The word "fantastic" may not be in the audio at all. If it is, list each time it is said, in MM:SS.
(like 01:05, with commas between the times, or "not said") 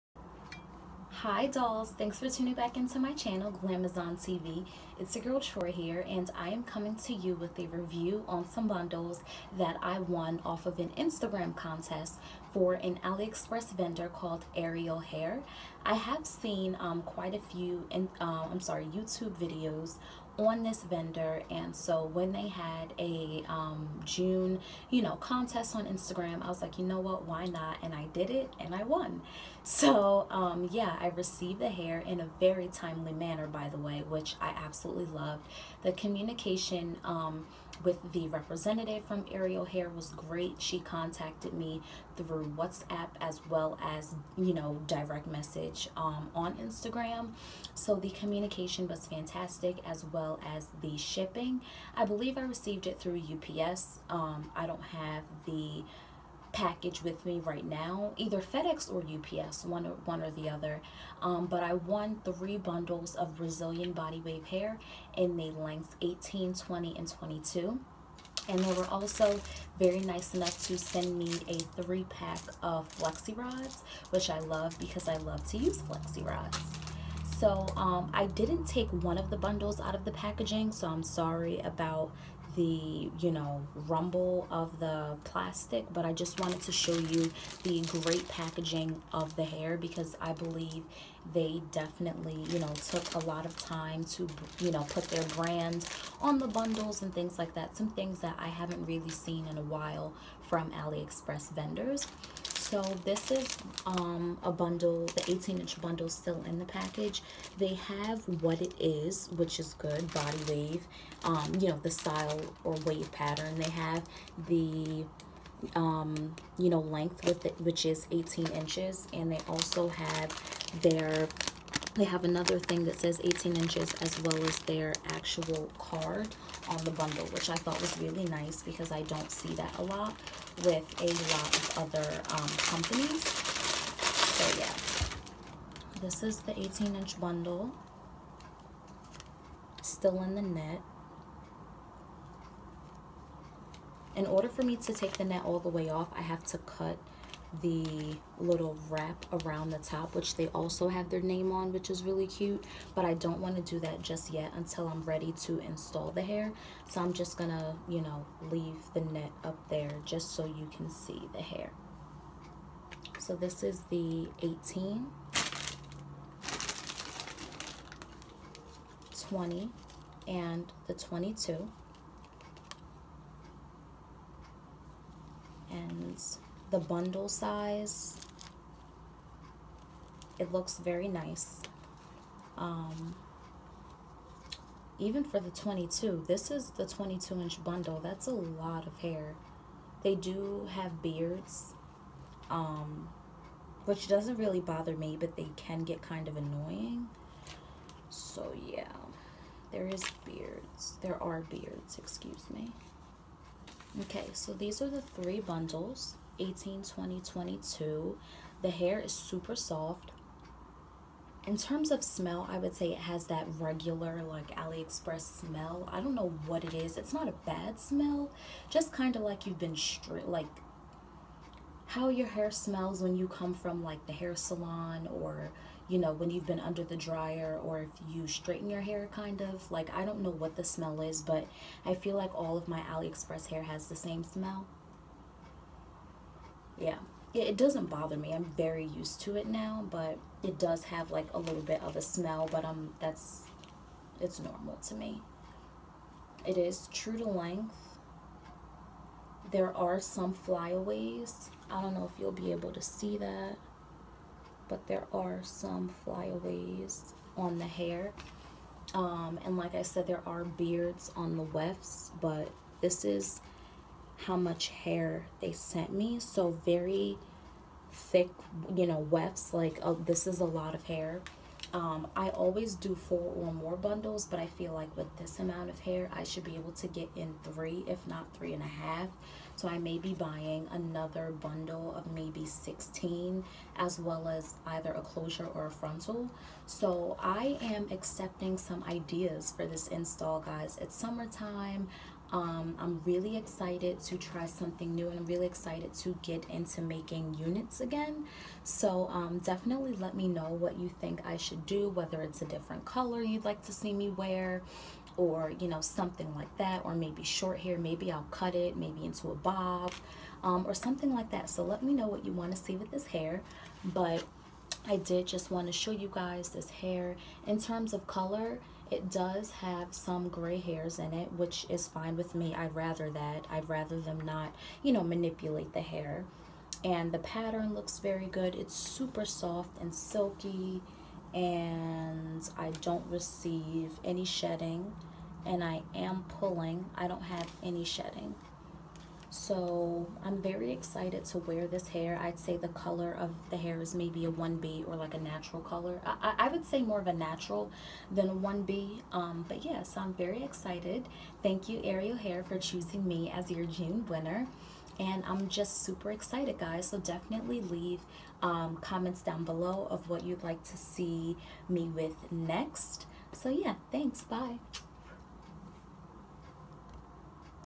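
00:49.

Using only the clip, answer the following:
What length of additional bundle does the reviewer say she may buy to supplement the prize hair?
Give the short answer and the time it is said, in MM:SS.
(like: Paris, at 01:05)
16 inches, at 04:42.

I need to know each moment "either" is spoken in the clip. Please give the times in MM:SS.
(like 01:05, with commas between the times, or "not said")
00:58, 04:44.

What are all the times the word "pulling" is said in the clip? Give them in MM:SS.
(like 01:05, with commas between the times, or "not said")
05:36.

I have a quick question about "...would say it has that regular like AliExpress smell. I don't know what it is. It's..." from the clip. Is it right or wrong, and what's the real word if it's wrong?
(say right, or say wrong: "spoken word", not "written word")
right.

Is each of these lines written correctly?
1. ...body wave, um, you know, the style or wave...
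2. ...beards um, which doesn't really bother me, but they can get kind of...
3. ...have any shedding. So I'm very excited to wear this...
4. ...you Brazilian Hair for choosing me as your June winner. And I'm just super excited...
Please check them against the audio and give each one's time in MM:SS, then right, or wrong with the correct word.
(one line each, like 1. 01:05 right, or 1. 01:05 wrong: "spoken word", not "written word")
1. 01:50 right
2. 03:11 right
3. 05:37 right
4. 05:51 wrong: "Ariel", not "Brazilian".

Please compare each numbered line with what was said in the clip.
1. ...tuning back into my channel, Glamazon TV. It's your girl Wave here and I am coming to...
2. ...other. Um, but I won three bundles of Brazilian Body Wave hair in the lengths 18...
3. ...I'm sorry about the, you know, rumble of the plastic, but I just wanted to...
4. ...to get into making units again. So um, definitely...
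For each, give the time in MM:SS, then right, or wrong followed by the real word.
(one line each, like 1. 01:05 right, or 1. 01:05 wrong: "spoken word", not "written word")
1. 00:02 wrong: "Troy", not "Wave"
2. 01:00 right
3. 01:20 right
4. 04:55 right.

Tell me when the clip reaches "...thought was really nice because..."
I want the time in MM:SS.
02:07.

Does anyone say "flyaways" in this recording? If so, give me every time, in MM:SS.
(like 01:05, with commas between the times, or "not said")
04:10, 04:16.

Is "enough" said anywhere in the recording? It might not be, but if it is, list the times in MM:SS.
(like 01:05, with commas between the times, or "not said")
01:10.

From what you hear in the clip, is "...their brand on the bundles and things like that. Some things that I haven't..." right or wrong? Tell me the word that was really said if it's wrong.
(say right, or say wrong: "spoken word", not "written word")
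right.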